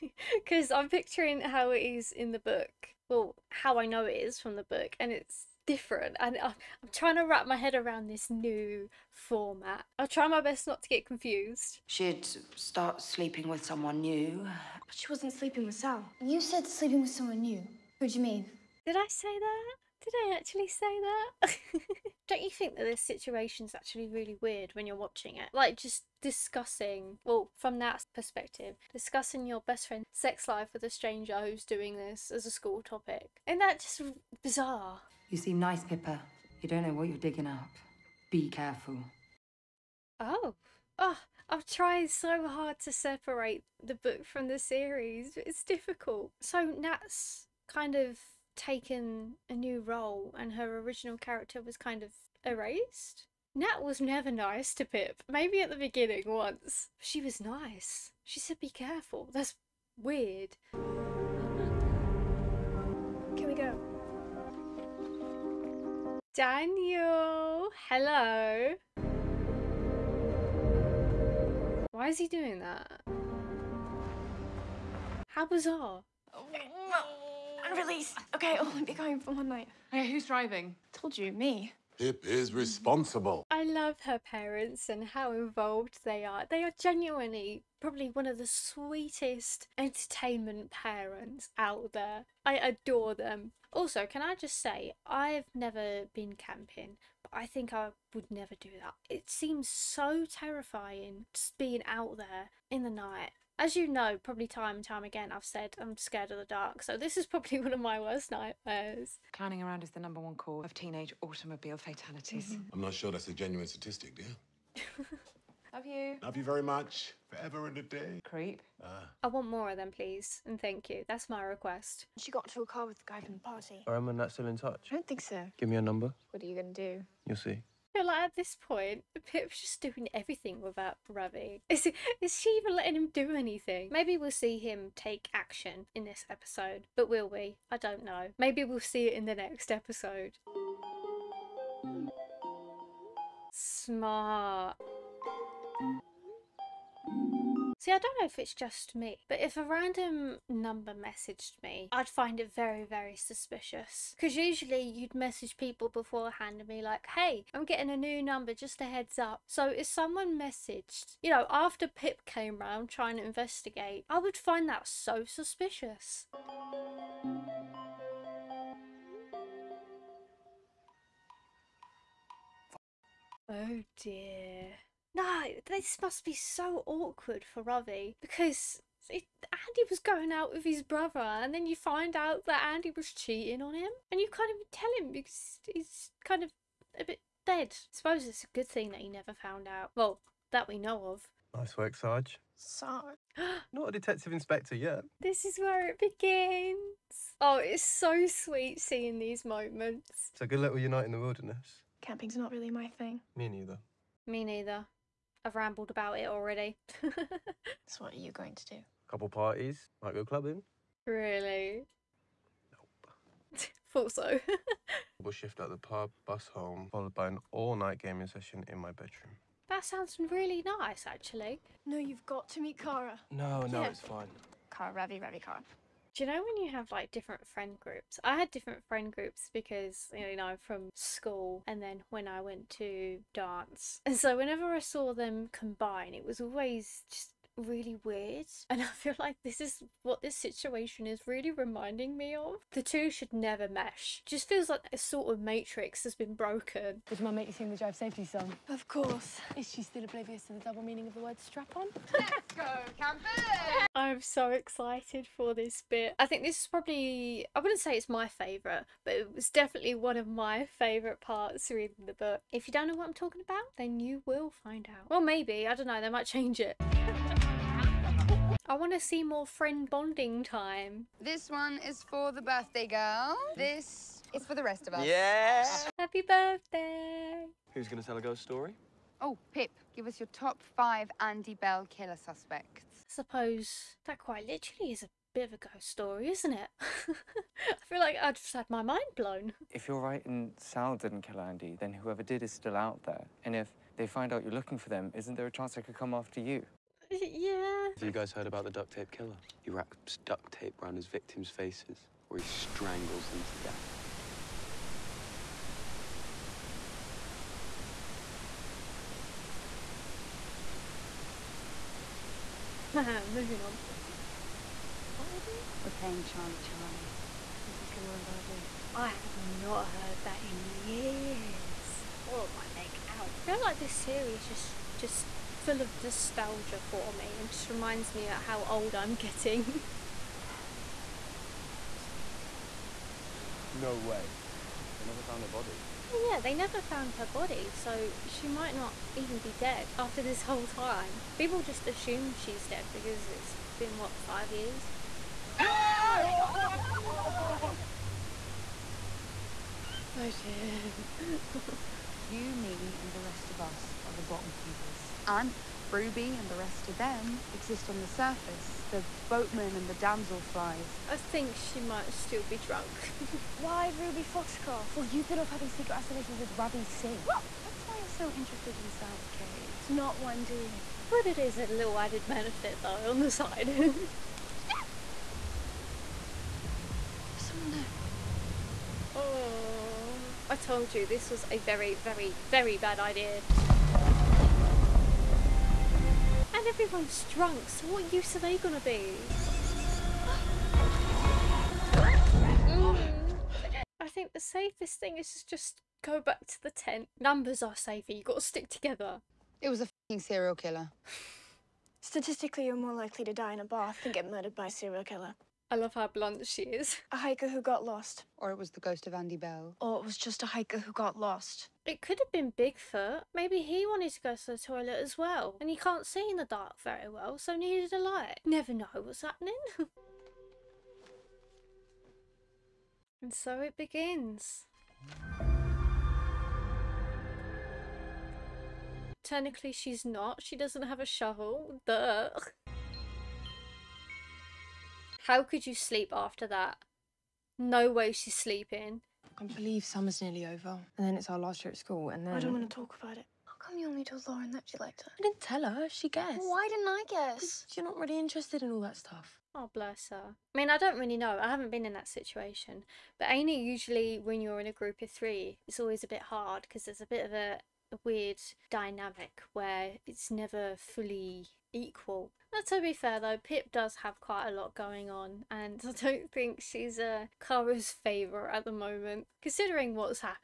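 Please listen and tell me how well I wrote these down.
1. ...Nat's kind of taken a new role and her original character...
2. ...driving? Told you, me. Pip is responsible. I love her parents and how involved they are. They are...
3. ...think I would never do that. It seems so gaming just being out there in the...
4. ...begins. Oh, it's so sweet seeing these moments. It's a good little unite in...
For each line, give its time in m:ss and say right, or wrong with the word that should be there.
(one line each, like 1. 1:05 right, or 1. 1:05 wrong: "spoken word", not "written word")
1. 0:46 right
2. 1:20 right
3. 1:37 wrong: "terrifying", not "gaming"
4. 3:15 right.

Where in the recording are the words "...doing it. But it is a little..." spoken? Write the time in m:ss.
6:10.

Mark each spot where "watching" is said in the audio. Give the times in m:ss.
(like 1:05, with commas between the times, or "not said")
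0:24.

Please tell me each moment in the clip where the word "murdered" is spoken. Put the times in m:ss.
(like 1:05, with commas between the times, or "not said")
6:44.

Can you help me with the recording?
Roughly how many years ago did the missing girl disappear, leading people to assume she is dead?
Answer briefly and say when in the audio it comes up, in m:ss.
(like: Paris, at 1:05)
5, at 5:44.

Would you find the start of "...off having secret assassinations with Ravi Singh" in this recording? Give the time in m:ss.
6:05.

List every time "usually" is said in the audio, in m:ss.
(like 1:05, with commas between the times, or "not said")
2:34, 7:33.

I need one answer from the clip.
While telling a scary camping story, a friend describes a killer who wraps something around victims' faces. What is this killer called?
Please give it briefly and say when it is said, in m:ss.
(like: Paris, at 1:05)
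the duct tape killer, at 4:58.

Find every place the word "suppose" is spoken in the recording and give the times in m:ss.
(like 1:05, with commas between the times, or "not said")
3:07, 4:43.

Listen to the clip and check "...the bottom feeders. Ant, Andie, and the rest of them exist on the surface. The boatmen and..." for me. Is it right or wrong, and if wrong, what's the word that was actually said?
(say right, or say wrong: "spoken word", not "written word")
wrong: "Ruby", not "Andie".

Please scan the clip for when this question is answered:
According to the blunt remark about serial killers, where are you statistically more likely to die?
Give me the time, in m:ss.
6:43.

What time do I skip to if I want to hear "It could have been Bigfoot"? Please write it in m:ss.
6:51.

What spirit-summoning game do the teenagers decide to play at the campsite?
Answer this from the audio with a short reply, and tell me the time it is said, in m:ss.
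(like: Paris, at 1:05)
Charlie Charlie, at 5:16.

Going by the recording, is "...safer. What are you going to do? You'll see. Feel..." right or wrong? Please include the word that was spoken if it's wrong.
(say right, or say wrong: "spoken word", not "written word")
wrong: "number", not "safer".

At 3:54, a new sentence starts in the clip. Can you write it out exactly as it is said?
And so whenever I saw them combine, it was always just really weird.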